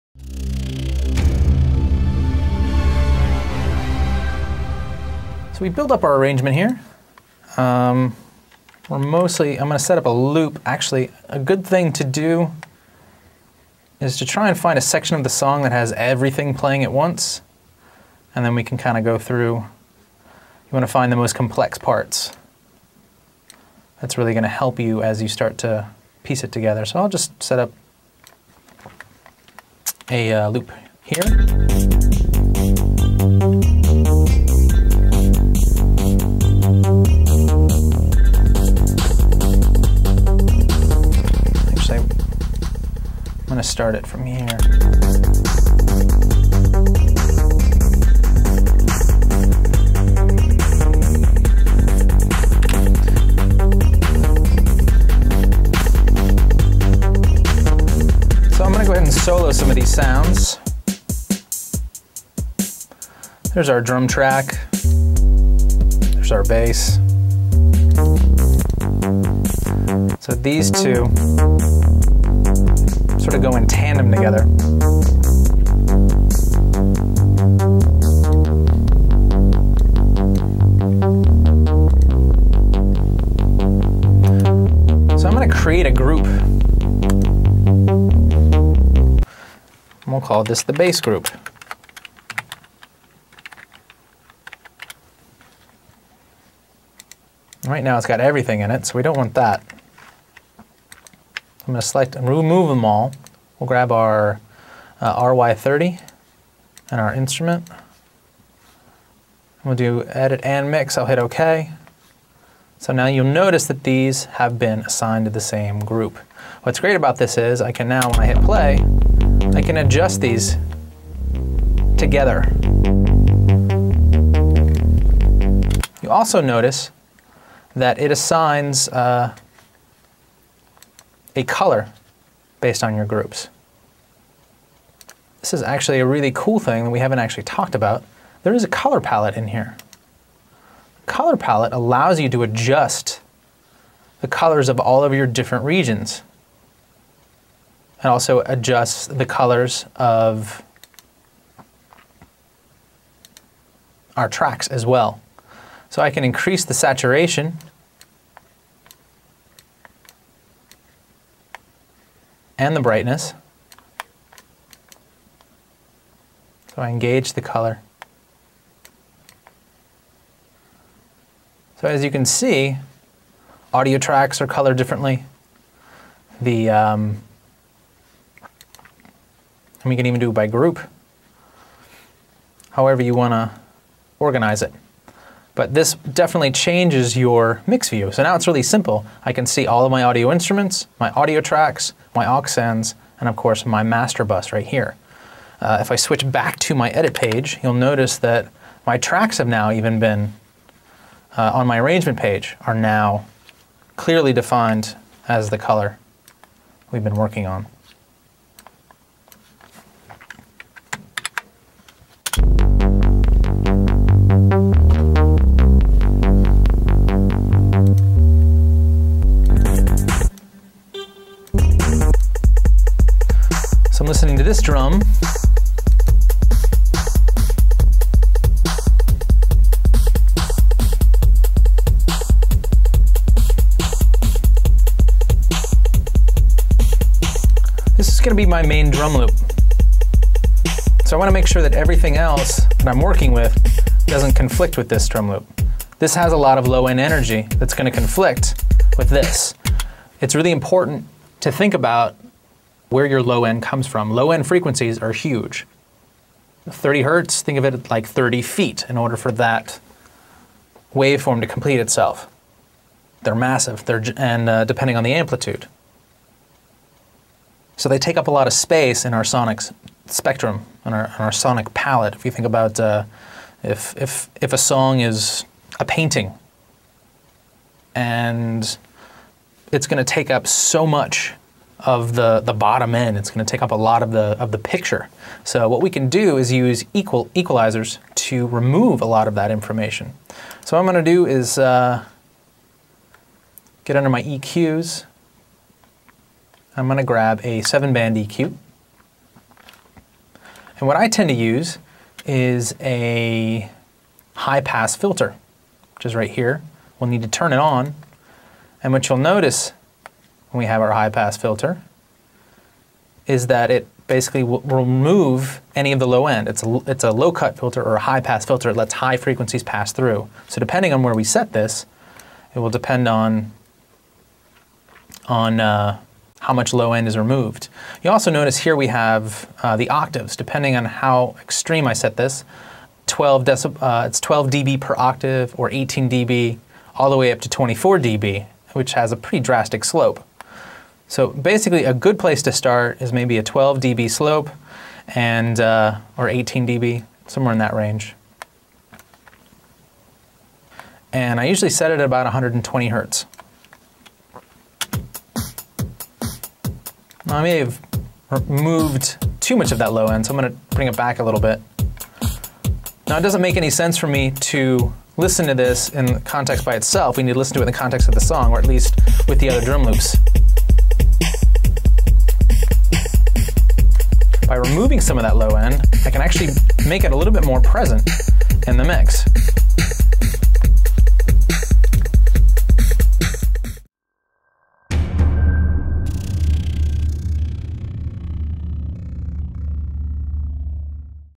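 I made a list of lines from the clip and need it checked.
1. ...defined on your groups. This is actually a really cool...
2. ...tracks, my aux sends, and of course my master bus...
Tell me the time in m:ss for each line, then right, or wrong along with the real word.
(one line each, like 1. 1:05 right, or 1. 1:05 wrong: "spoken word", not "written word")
1. 2:12 wrong: "based", not "defined"
2. 3:11 right.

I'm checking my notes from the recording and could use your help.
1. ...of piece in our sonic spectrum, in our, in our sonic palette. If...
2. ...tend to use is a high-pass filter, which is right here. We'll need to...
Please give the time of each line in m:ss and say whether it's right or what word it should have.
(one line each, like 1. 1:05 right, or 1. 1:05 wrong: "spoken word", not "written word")
1. 4:28 wrong: "space", not "piece"
2. 5:01 right.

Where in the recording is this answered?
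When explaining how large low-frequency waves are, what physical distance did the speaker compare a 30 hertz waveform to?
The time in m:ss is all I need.
4:18.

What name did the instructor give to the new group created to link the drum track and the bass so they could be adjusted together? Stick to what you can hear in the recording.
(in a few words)
bass group.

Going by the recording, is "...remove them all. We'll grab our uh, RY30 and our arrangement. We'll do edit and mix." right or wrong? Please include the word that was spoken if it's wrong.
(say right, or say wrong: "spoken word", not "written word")
wrong: "instrument", not "arrangement".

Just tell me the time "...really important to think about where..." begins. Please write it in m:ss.
4:10.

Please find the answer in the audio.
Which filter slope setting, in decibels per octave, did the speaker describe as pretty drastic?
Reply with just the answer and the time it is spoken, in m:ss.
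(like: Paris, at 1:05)
24 dB, at 5:37.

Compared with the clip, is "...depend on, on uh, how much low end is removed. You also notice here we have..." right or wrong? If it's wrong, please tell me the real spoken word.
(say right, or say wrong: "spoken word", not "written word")
right.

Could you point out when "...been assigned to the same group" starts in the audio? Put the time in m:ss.
1:54.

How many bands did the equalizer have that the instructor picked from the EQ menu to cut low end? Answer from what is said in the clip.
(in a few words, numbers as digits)
7.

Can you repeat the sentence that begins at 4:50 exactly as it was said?
So what I'm going to do is uh, get under my EQs.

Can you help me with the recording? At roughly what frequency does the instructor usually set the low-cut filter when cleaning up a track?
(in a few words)
120 Hz.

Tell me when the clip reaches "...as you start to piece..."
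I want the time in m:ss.
0:25.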